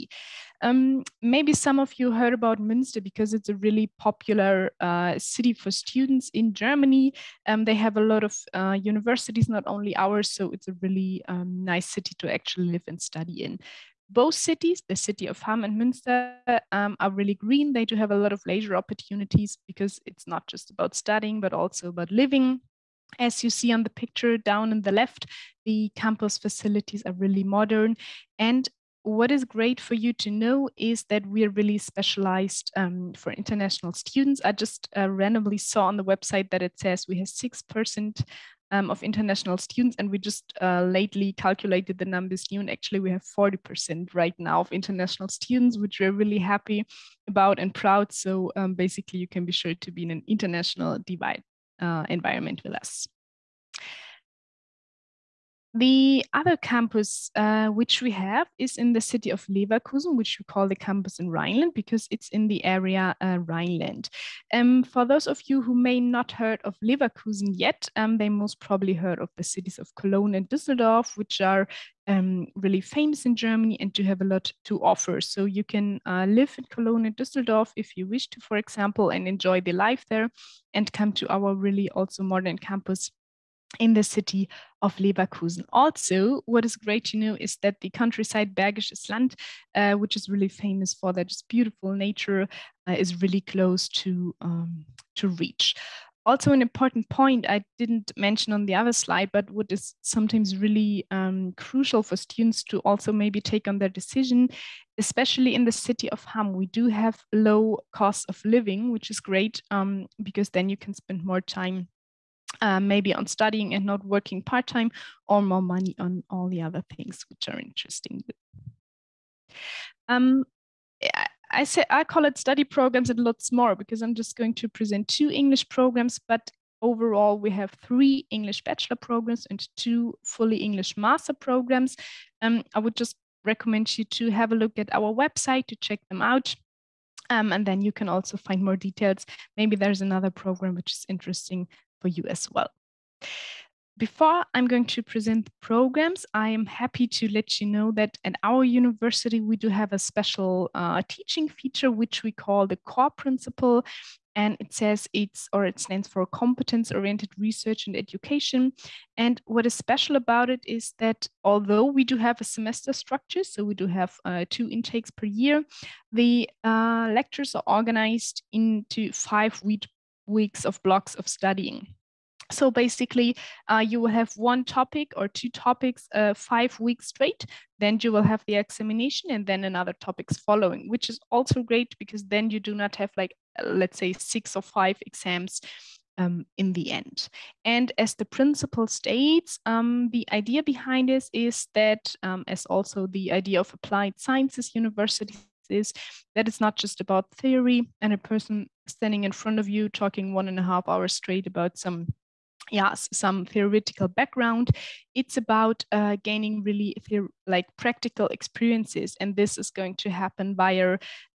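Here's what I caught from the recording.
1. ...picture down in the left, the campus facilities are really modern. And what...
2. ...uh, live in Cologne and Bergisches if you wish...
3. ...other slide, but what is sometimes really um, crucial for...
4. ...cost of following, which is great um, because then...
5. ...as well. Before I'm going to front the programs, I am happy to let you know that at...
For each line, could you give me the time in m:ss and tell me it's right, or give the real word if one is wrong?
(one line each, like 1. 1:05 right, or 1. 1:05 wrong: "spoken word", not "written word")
1. 0:23 right
2. 1:16 wrong: "Düsseldorf", not "Bergisches"
3. 1:38 right
4. 1:47 wrong: "living", not "following"
5. 2:22 wrong: "present", not "front".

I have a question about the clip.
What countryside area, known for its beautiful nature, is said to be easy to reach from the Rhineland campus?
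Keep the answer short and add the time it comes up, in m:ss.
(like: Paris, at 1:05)
Bergisches Land, at 1:28.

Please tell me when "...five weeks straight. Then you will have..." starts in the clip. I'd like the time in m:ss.
2:56.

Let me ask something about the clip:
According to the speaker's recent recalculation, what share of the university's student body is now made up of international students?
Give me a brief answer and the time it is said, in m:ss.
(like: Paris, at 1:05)
40%, at 0:43.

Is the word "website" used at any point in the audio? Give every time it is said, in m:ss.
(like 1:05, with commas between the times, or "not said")
0:36, 2:15.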